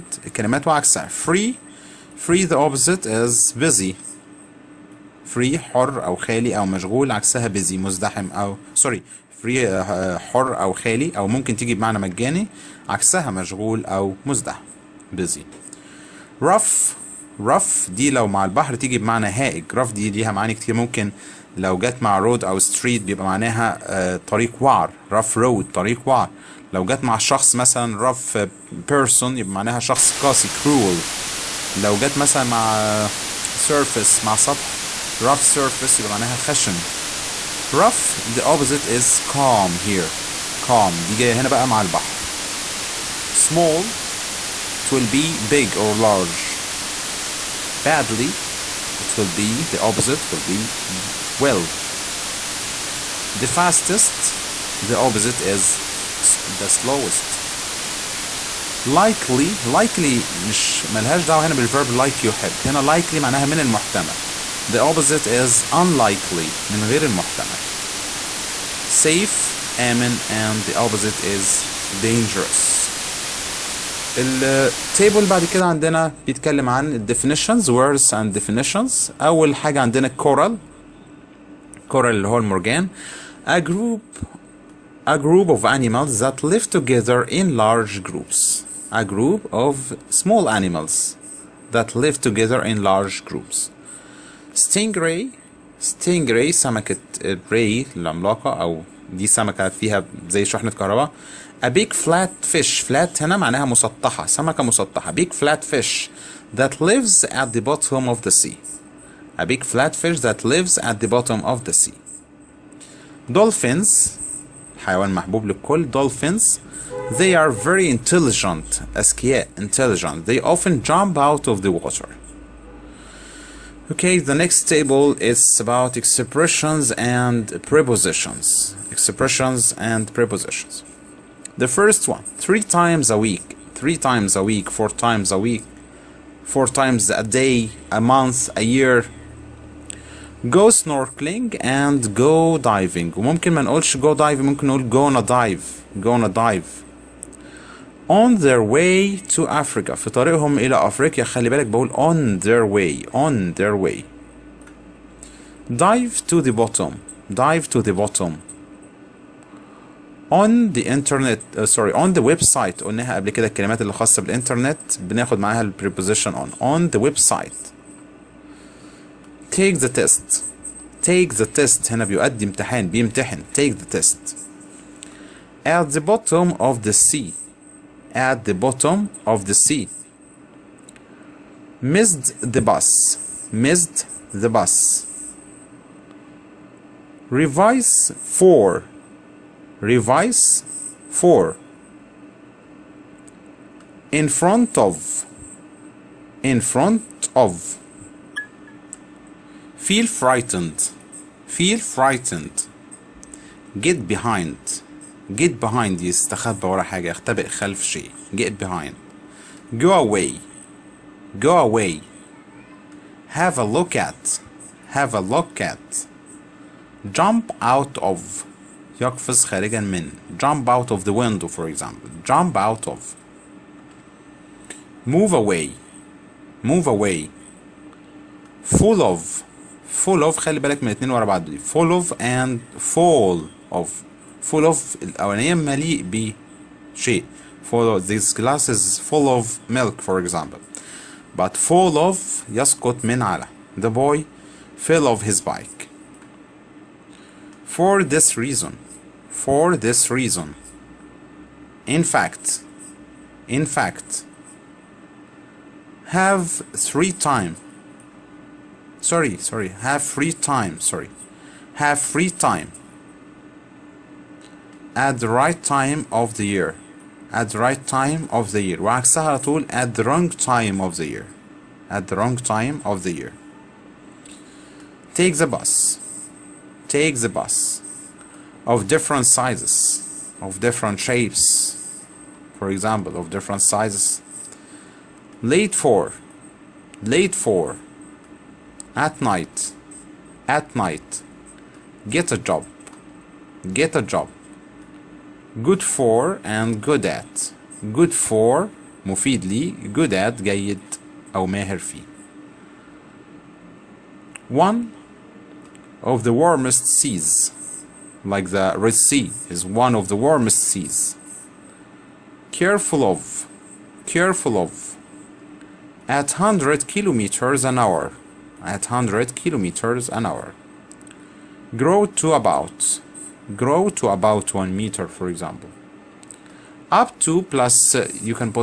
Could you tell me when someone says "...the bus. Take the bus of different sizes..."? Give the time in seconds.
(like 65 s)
275 s.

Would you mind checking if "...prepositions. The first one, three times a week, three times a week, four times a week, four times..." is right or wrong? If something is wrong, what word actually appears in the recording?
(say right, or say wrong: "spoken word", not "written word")
right.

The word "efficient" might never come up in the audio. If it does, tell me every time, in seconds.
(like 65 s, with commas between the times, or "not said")
not said.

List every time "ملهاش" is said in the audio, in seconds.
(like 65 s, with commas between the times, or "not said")
60 s.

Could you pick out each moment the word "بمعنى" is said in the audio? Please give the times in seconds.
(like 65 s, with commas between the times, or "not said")
11 s, 18 s.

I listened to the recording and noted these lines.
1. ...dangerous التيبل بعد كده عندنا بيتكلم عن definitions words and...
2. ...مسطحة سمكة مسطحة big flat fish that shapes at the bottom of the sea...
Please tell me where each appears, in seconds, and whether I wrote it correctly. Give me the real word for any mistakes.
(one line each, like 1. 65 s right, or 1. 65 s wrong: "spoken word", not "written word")
1. 72 s right
2. 103 s wrong: "lives", not "shapes".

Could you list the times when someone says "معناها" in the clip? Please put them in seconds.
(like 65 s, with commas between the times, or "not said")
23 s, 29 s, 36 s, 63 s, 103 s.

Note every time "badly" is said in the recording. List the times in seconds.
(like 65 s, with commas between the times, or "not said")
47 s.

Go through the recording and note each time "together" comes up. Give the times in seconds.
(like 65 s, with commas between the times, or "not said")
86 s, 92 s.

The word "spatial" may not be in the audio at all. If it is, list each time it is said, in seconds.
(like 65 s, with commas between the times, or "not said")
not said.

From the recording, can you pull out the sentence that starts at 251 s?
In fact, in fact, have three time.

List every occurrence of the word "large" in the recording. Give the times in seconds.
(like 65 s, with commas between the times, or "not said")
45 s, 87 s, 92 s.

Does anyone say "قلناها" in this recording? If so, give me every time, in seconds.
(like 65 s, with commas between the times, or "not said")
162 s.